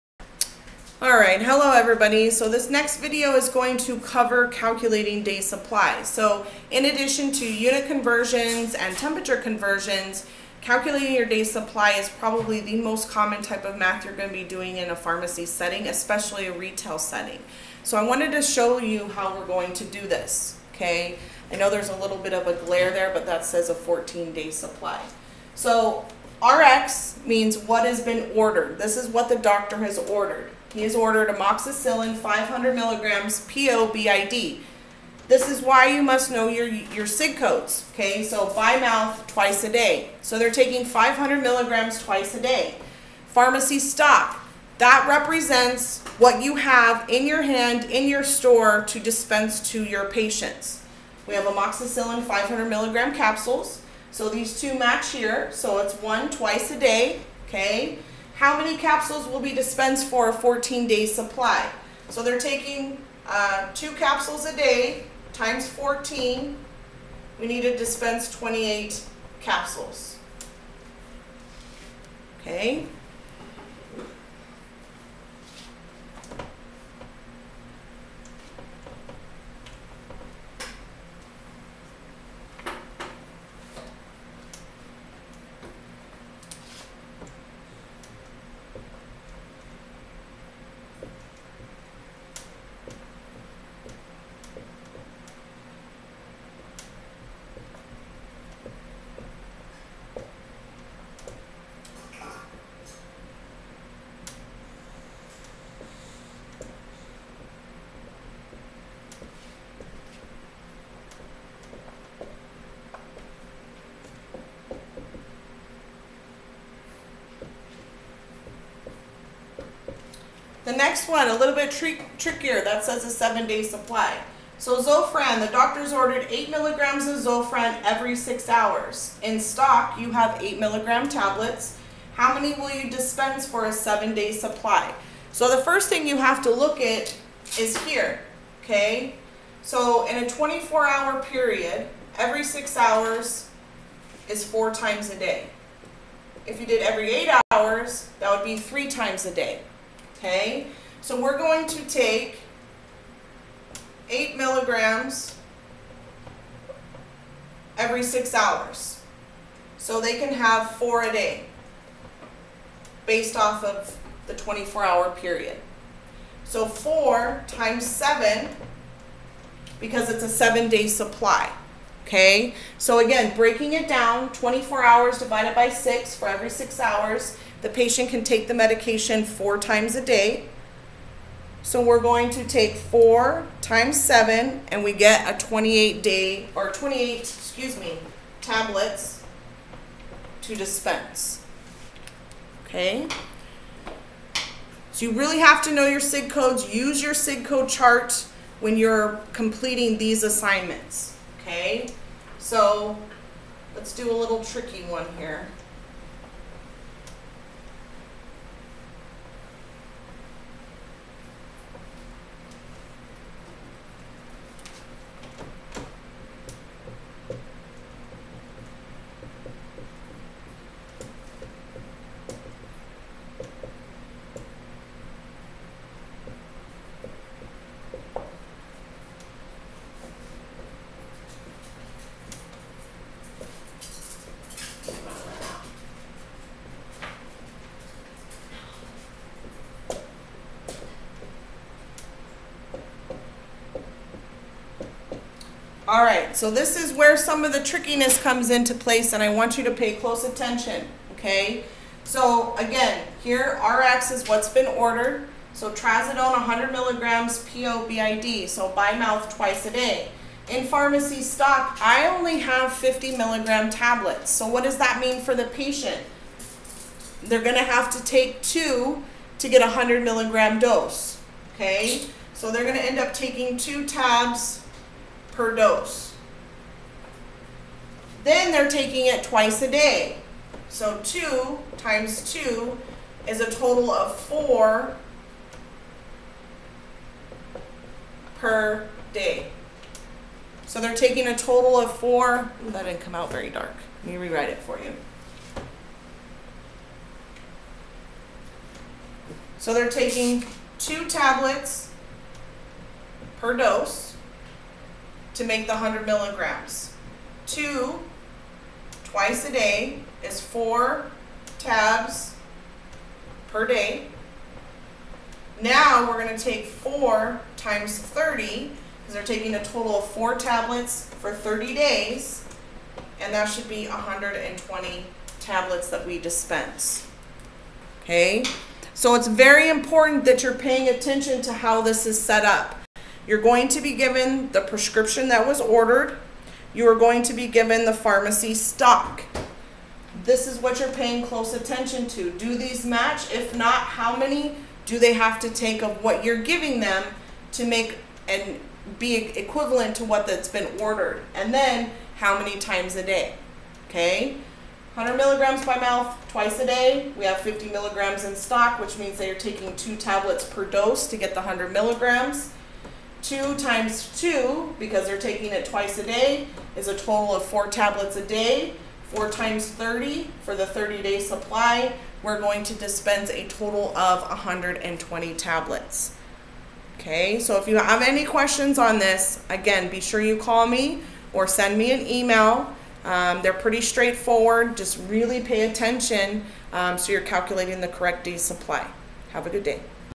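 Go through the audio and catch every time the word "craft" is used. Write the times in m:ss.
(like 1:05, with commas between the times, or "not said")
not said.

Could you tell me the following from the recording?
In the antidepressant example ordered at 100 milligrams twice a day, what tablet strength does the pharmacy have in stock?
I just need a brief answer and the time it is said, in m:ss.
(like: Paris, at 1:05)
50 milligrams, at 4:22.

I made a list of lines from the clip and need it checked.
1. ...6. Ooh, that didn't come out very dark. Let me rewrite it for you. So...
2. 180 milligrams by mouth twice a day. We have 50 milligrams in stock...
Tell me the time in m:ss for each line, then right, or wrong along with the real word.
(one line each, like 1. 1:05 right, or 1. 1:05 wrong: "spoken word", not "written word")
1. 4:51 wrong: "4", not "6"
2. 5:54 wrong: "100", not "180".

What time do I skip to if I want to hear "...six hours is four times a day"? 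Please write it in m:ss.
2:22.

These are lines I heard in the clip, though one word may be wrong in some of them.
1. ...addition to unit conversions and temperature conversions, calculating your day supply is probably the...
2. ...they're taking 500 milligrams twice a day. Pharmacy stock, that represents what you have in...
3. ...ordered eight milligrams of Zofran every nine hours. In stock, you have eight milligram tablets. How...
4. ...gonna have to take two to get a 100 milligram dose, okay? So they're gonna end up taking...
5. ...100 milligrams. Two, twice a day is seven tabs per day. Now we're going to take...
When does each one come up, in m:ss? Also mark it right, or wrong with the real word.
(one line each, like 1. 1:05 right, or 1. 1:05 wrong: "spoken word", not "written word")
1. 0:06 right
2. 0:40 right
3. 2:05 wrong: "six", not "nine"
4. 4:27 right
5. 5:05 wrong: "four", not "seven".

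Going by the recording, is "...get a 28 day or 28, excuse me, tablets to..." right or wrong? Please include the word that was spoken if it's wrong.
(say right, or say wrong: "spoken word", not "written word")
right.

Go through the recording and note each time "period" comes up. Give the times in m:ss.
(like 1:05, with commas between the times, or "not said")
2:21, 2:45.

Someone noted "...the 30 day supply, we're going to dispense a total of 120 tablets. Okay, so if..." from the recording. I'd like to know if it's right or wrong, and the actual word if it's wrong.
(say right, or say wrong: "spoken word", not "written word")
right.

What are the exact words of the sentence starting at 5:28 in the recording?
Okay, so it's very important that you're paying attention to how this is set up.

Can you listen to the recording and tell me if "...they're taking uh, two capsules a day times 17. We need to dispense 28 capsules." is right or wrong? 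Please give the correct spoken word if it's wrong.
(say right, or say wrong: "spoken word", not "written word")
wrong: "14", not "17".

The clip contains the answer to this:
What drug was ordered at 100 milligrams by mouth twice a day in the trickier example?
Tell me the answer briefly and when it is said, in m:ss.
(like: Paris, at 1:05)
trazodone, at 4:15.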